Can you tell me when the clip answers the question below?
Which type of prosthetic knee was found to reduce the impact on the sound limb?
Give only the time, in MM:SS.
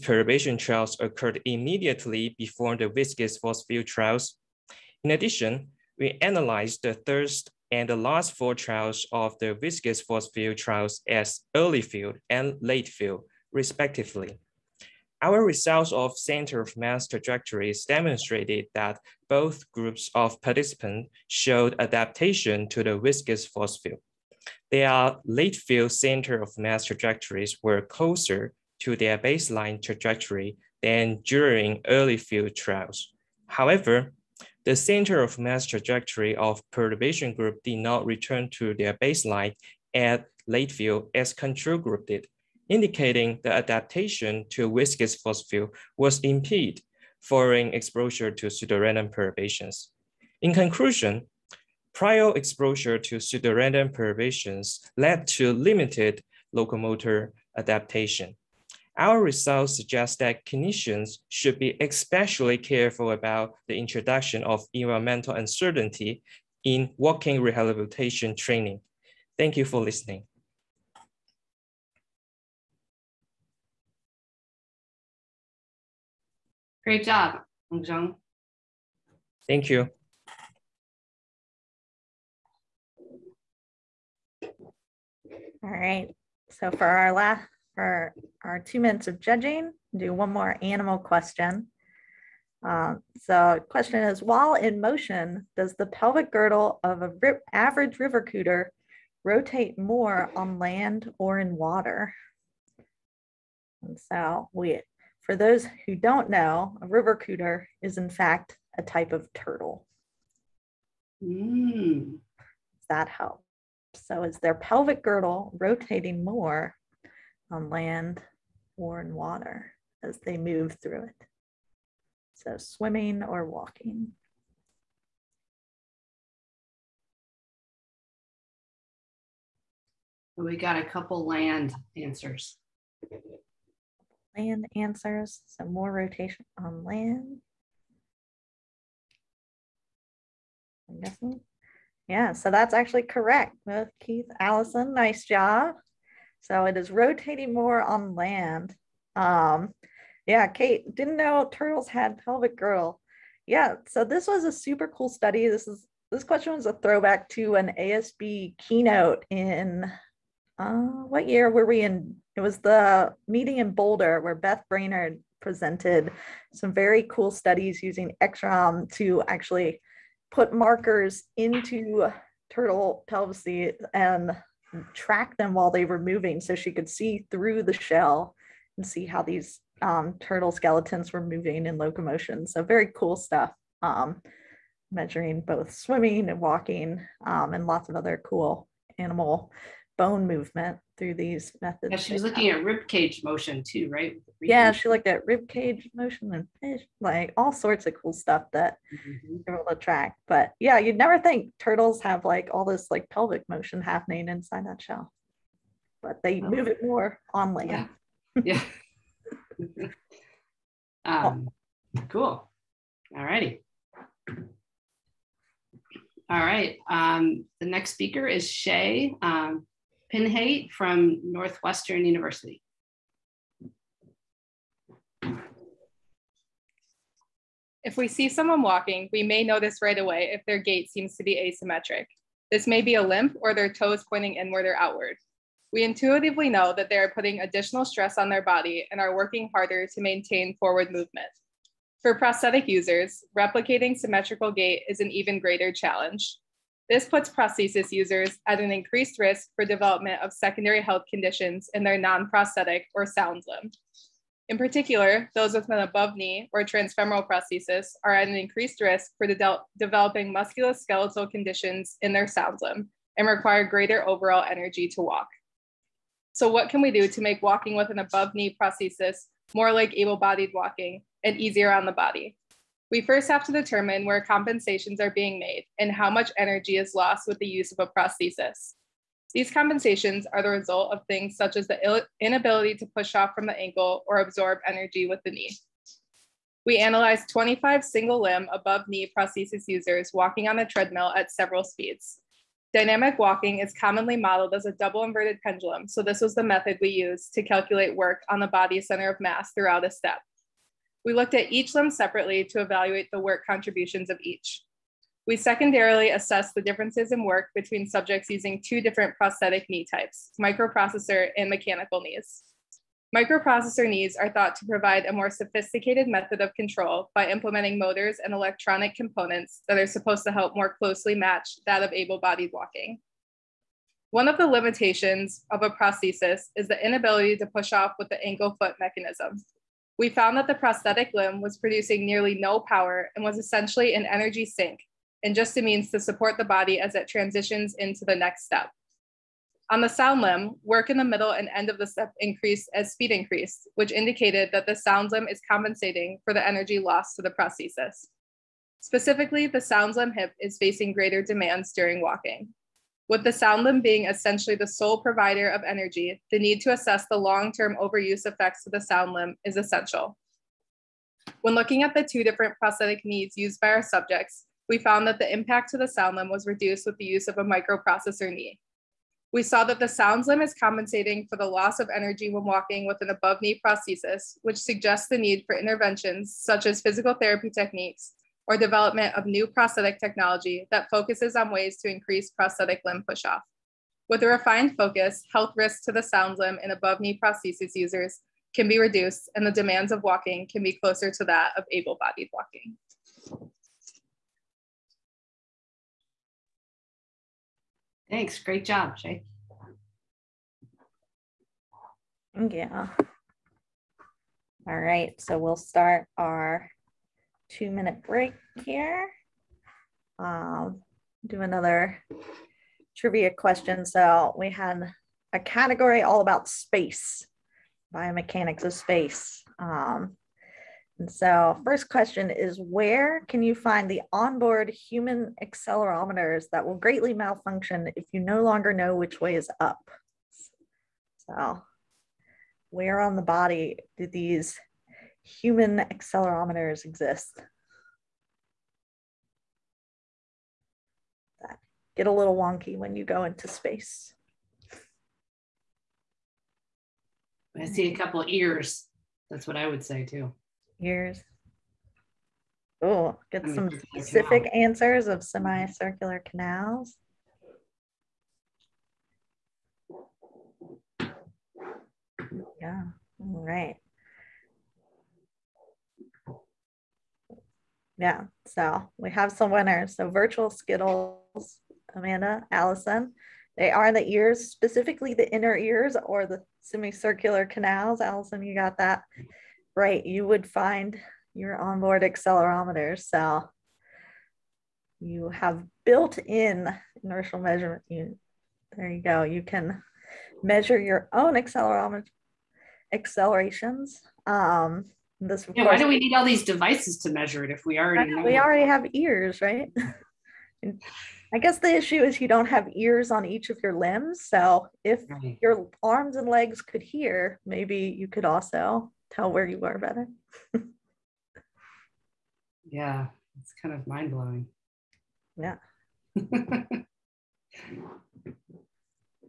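06:07.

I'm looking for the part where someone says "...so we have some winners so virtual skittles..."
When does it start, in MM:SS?
07:48.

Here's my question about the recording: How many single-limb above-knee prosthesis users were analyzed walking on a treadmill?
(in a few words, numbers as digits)
25.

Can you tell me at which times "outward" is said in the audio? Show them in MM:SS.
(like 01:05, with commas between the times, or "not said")
03:54.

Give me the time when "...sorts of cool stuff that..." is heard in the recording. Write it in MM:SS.
03:17.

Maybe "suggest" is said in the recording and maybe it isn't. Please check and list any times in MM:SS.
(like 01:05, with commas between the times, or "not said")
00:59, 06:14.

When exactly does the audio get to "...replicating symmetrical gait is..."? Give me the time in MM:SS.
04:03.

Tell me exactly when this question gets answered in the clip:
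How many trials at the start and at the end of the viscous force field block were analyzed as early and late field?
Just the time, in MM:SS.
00:08.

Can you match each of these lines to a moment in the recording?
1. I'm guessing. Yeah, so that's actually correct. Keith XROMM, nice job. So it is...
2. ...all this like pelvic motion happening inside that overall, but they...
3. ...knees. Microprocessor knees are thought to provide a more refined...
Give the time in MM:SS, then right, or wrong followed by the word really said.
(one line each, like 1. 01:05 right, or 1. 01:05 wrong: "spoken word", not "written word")
1. 02:20 wrong: "Allison", not "XROMM"
2. 03:22 wrong: "shell", not "overall"
3. 05:12 wrong: "sophisticated", not "refined".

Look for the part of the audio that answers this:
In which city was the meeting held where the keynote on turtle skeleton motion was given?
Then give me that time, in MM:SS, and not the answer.
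02:43.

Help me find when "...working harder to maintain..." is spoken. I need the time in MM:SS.
03:59.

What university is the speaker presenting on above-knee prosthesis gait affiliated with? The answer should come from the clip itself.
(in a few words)
Northwestern University.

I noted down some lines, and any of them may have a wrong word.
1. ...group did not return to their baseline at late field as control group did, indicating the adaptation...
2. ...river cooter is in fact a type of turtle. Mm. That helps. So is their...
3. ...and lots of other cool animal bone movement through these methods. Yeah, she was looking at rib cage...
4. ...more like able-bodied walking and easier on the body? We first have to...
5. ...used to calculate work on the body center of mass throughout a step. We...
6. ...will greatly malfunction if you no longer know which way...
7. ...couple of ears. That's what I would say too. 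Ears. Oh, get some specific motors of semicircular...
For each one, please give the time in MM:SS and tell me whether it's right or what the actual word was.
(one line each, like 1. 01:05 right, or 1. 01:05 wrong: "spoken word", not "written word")
1. 00:37 right
2. 01:46 right
3. 03:07 right
4. 04:29 right
5. 04:56 right
6. 07:06 right
7. 07:27 wrong: "answers", not "motors".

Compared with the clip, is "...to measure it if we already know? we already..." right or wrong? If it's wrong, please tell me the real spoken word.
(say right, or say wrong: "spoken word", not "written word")
right.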